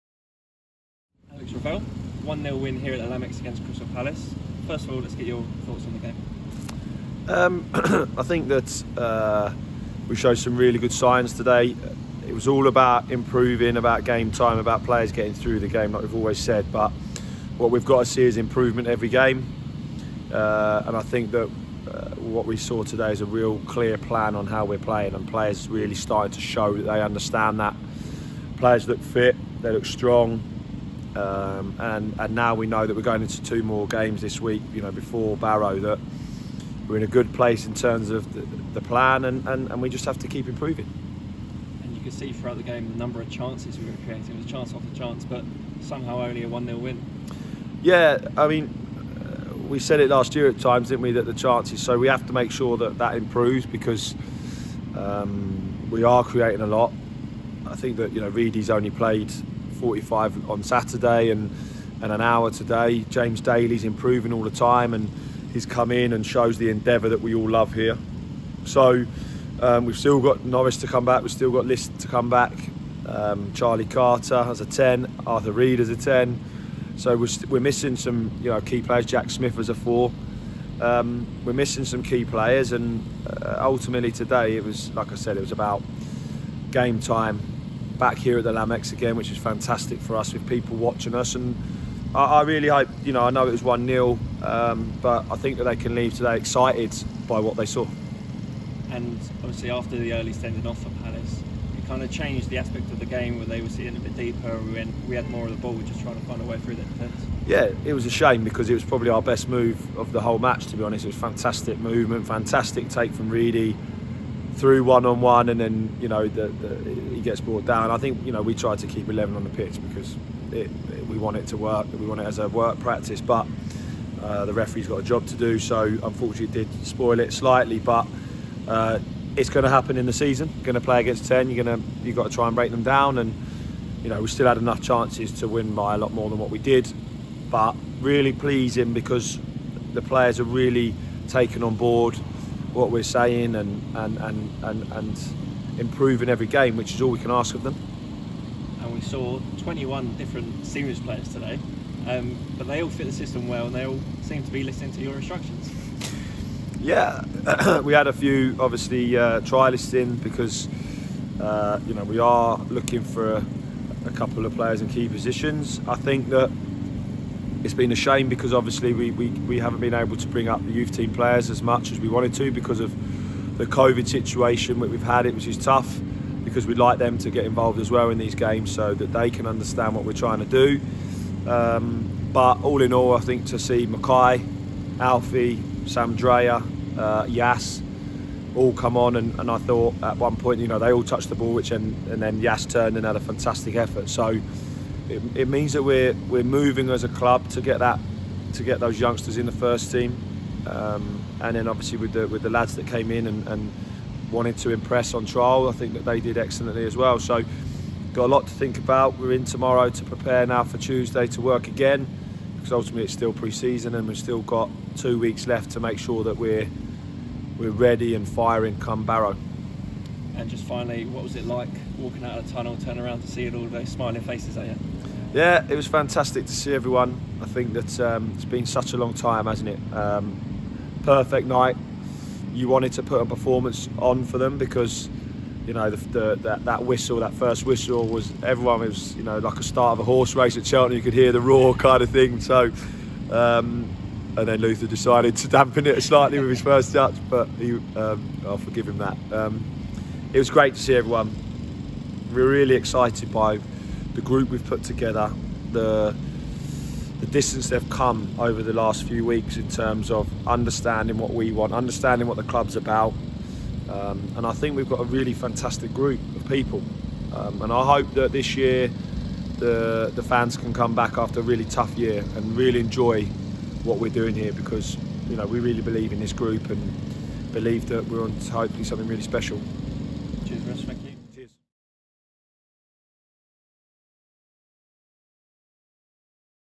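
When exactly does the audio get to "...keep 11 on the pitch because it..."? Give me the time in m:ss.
1:58.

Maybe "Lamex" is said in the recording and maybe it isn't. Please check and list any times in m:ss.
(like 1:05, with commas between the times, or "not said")
0:03, 1:28.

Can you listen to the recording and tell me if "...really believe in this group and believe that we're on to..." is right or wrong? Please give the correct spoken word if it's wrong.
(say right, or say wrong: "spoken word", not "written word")
right.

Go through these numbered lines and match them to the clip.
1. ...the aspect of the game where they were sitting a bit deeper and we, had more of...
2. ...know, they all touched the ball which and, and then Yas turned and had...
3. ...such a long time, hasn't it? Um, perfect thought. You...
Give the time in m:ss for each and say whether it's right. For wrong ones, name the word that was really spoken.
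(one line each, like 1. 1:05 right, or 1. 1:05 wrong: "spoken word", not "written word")
1. 1:42 right
2. 3:10 right
3. 3:48 wrong: "night", not "thought".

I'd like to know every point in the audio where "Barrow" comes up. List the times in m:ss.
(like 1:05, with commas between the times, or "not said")
0:35, 3:39.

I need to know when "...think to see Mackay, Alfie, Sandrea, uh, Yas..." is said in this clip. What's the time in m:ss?
3:03.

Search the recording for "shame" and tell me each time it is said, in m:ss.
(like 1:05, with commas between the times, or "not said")
1:48, 2:47.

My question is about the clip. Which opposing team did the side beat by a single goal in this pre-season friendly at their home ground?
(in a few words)
Crystal Palace.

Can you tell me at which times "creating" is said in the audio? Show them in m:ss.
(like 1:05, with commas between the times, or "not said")
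0:44, 0:56.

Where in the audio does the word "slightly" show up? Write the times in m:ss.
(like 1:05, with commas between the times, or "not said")
2:07, 4:06.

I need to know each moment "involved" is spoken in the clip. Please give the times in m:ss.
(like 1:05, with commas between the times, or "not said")
2:57.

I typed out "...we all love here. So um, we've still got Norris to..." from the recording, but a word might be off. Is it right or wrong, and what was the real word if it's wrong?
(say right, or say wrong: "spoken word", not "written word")
right.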